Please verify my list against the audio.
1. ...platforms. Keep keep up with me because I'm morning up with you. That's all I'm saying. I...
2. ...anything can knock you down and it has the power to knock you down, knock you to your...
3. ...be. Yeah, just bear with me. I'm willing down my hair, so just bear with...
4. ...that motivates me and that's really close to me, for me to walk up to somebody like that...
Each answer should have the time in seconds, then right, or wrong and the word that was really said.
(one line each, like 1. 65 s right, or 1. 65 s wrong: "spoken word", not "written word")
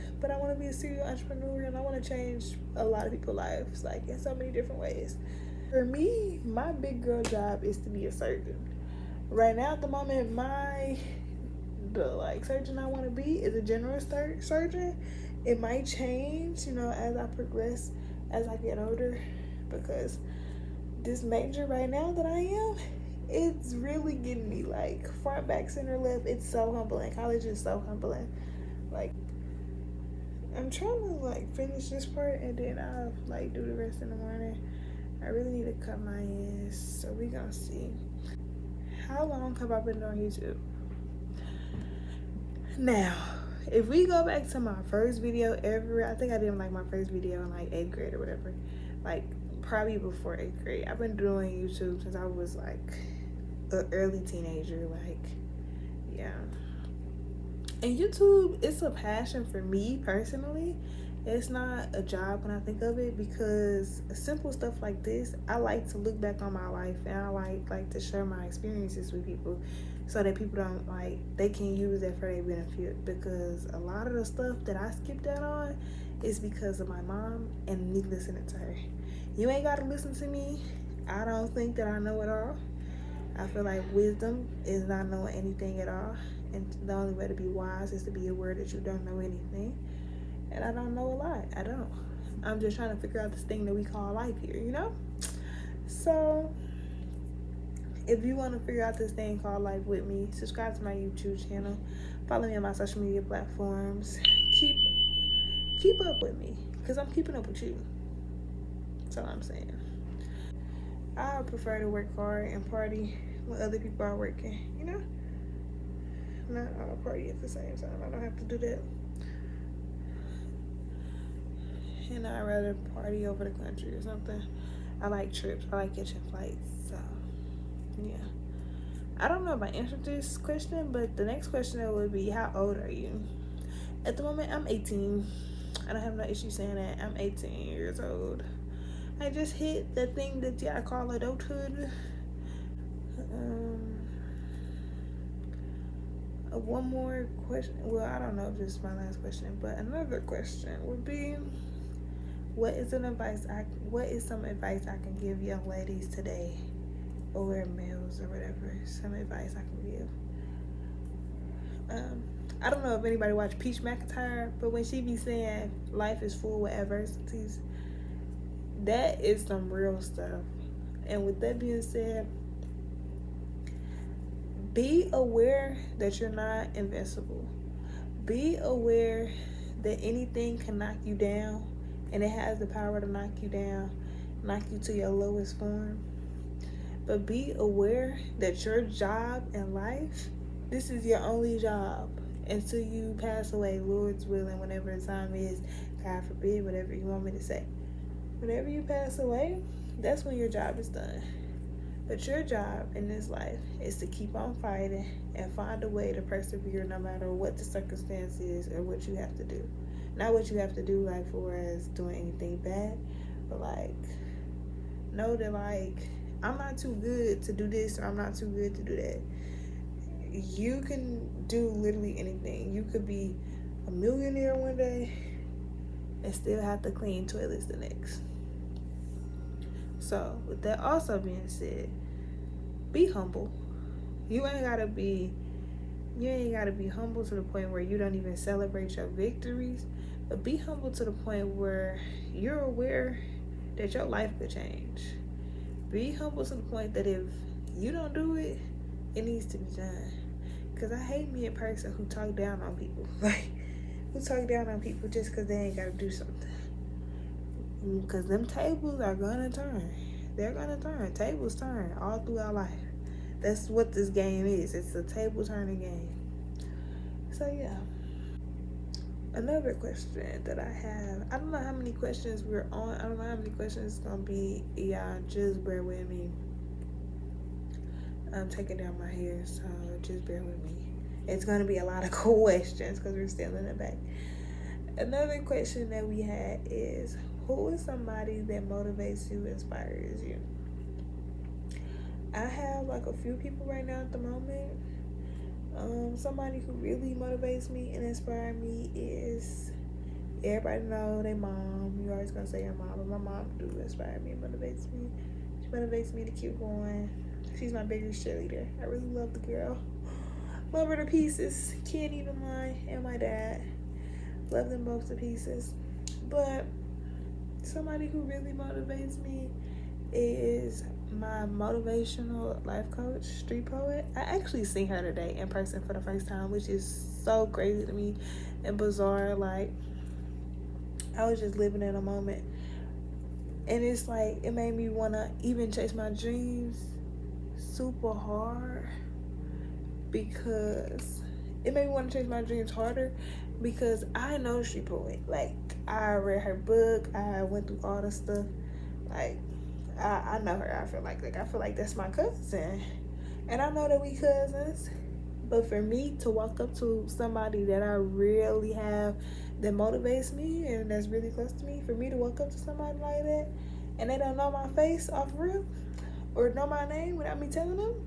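1. 103 s wrong: "keeping", not "morning"
2. 180 s right
3. 274 s wrong: "taking", not "willing"
4. 359 s right.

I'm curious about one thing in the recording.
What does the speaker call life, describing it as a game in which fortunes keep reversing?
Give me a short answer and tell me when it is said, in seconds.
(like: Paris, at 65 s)
A table turning game, at 265 s.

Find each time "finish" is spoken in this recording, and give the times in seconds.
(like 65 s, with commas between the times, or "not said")
31 s.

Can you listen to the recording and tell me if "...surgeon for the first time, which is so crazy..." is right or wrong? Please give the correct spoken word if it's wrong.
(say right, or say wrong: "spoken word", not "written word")
wrong: "person", not "surgeon".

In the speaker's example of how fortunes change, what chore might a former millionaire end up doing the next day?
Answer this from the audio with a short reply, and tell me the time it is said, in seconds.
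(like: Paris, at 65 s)
Clean toilets, at 226 s.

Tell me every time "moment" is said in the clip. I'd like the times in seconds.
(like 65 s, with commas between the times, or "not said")
9 s, 134 s, 294 s, 332 s.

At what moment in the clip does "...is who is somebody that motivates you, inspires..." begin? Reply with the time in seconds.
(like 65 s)
286 s.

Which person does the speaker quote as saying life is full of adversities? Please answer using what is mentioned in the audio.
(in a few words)
Peach McIntyre.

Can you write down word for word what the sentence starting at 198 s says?
Whenever you pass away, that's when your job is done.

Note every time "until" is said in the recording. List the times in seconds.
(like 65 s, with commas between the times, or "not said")
192 s.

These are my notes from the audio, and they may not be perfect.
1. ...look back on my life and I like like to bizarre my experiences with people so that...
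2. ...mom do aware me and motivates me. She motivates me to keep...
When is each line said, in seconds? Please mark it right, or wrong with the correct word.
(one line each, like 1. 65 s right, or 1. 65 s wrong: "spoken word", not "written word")
1. 65 s wrong: "share", not "bizarre"
2. 303 s wrong: "inspire", not "aware".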